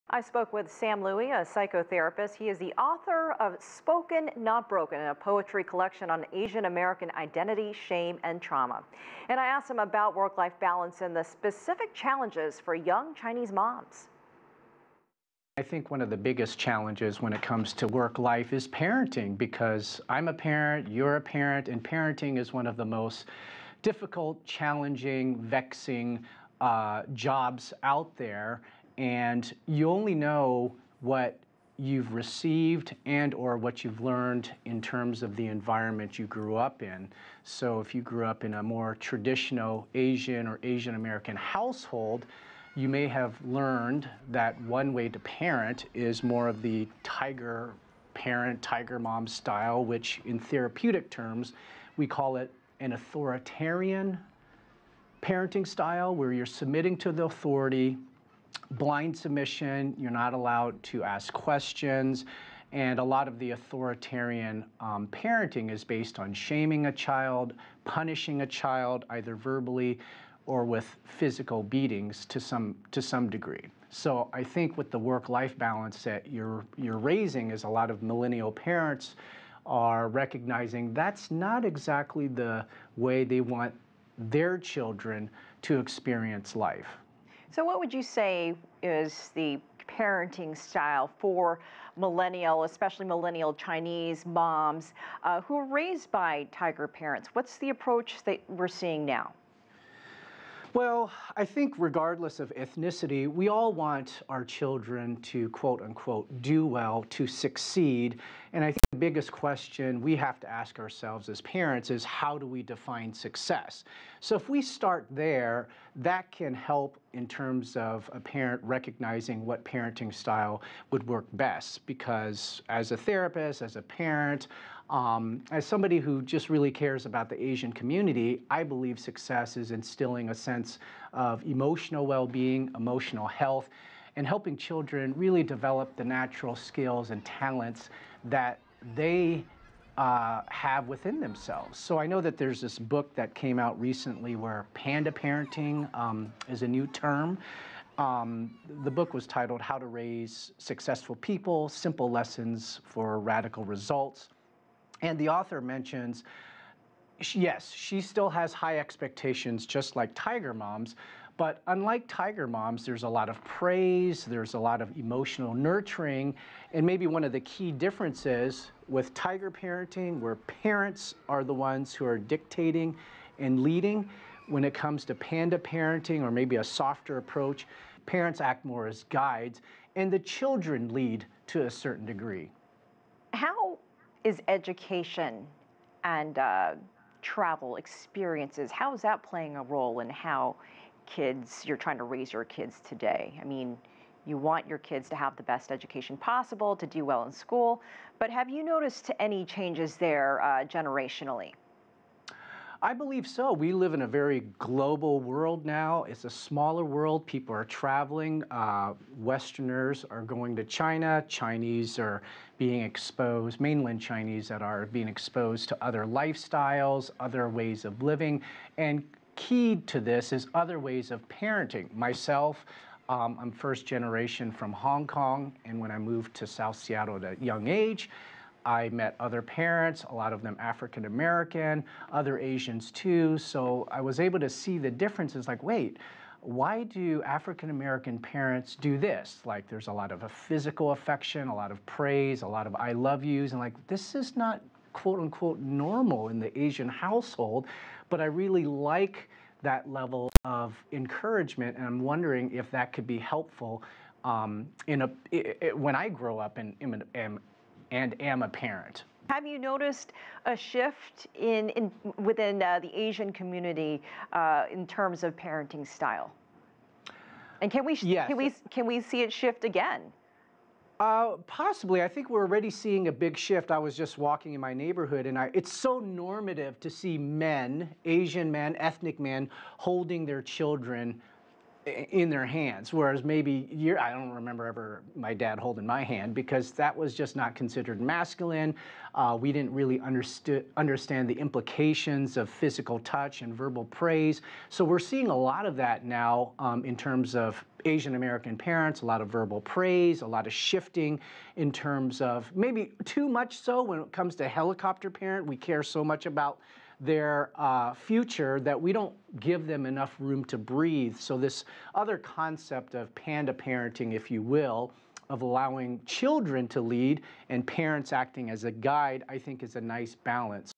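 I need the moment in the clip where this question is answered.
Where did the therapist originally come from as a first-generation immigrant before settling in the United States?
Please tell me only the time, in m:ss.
3:44.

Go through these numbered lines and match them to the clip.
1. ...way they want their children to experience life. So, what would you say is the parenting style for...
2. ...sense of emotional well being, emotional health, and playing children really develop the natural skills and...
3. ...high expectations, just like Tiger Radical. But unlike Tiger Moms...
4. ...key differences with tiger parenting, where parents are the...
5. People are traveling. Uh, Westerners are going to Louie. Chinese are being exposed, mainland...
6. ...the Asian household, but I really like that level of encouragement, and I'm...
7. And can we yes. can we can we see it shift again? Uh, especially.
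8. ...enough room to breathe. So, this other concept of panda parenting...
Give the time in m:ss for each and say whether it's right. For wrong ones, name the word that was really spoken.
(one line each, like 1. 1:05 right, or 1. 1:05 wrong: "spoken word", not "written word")
1. 1:22 right
2. 2:10 wrong: "helping", not "playing"
3. 2:38 wrong: "Moms", not "Radical"
4. 2:47 right
5. 3:27 wrong: "China", not "Louie"
6. 4:06 right
7. 4:27 wrong: "possibly", not "especially"
8. 5:09 right.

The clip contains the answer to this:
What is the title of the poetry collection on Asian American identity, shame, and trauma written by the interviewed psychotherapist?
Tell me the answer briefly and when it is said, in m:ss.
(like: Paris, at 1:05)
Spoken Not Broken, at 0:03.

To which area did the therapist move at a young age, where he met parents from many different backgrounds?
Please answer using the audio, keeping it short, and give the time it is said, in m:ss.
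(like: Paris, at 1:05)
South Seattle, at 3:46.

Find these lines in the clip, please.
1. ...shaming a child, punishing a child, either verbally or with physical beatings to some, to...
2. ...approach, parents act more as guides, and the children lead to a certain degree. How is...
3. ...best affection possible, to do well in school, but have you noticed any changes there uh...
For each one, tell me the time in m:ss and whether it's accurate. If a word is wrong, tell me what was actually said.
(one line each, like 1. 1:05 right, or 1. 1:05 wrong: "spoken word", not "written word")
1. 1:06 right
2. 2:57 right
3. 3:15 wrong: "education", not "affection".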